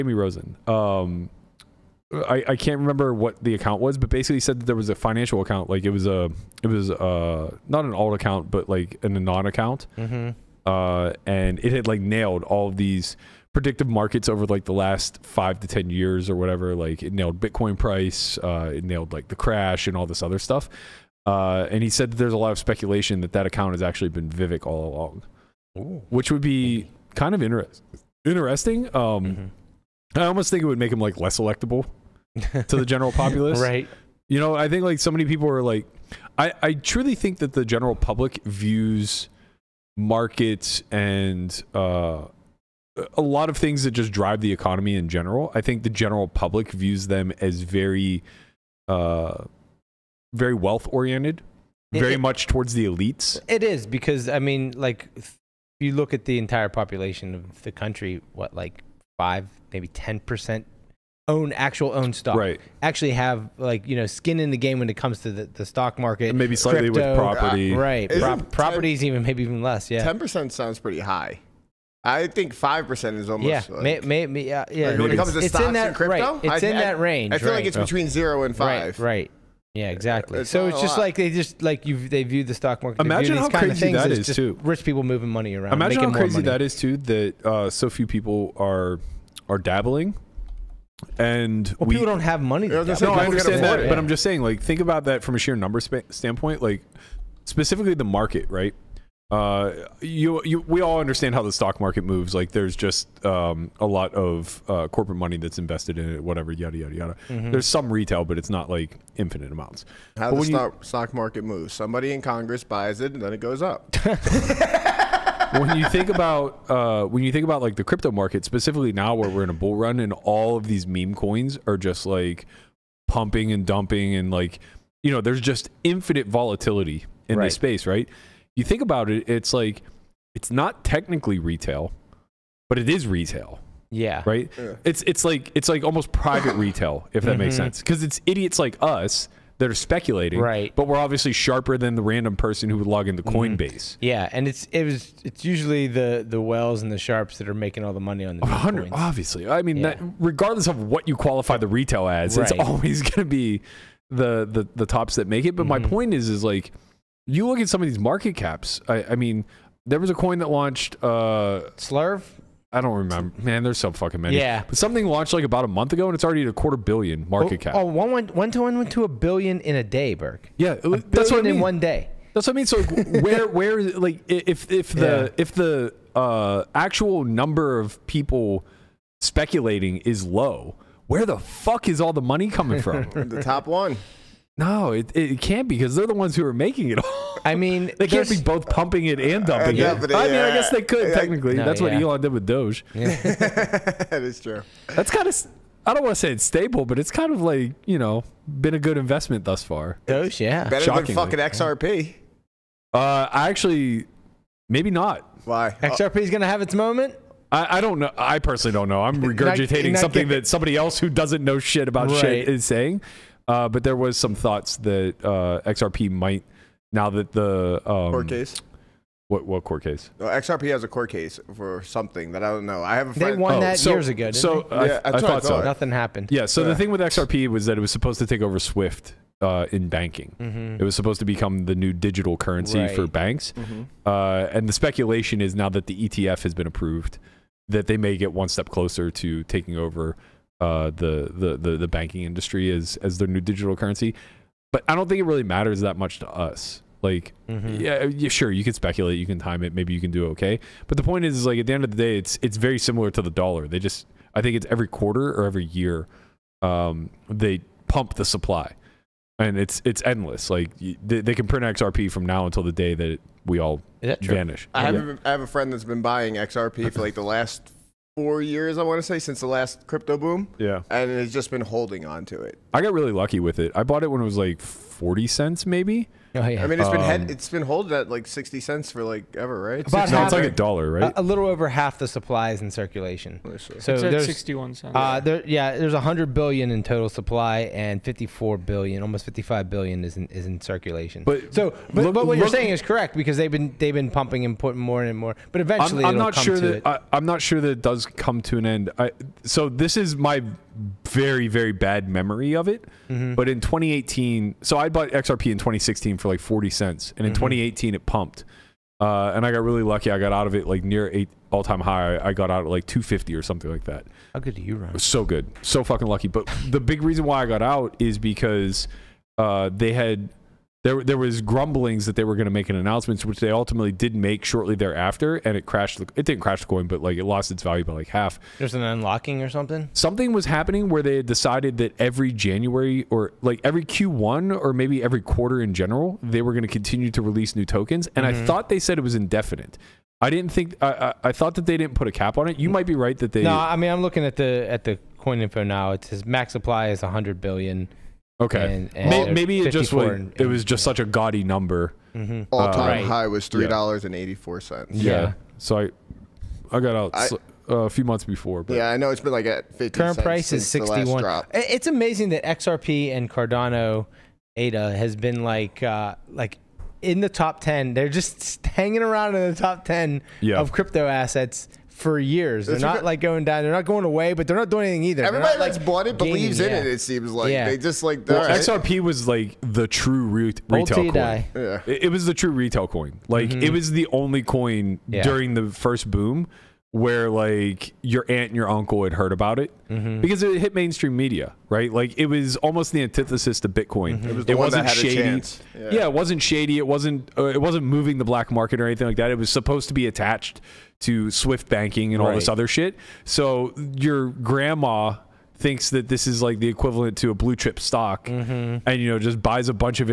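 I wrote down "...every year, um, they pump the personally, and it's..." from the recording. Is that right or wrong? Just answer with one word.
wrong.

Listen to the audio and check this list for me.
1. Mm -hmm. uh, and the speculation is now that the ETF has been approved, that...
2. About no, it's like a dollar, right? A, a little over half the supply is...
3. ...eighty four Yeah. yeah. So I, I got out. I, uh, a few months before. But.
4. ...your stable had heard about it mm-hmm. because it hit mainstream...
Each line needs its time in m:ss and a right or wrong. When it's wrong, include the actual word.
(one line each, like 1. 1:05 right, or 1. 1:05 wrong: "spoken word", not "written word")
1. 3:53 right
2. 4:39 right
3. 5:54 right
4. 6:28 wrong: "uncle", not "stable".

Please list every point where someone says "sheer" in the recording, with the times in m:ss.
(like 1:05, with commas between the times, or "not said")
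1:35.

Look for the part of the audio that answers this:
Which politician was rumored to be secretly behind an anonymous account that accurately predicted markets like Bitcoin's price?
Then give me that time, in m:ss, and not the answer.
0:24.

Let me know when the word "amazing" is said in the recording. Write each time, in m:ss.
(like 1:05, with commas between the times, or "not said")
6:01.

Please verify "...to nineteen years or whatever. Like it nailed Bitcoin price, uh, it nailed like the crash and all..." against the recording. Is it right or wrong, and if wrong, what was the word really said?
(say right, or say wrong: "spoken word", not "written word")
wrong: "ten", not "nineteen".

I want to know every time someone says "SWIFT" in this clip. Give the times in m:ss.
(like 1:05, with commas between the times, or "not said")
3:48, 6:41.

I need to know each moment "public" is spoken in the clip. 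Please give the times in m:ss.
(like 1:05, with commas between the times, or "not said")
0:37, 0:46.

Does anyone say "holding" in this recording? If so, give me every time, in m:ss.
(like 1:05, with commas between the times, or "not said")
4:31, 4:37.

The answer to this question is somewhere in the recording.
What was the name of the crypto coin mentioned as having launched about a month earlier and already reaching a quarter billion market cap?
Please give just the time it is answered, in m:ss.
2:41.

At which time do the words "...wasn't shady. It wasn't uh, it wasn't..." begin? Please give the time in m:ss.
6:36.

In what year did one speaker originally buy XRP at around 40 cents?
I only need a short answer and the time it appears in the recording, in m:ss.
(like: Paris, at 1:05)
2016, at 5:05.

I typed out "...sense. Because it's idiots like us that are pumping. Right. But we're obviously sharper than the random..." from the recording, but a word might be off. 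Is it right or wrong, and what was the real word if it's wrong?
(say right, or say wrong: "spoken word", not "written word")
wrong: "speculating", not "pumping".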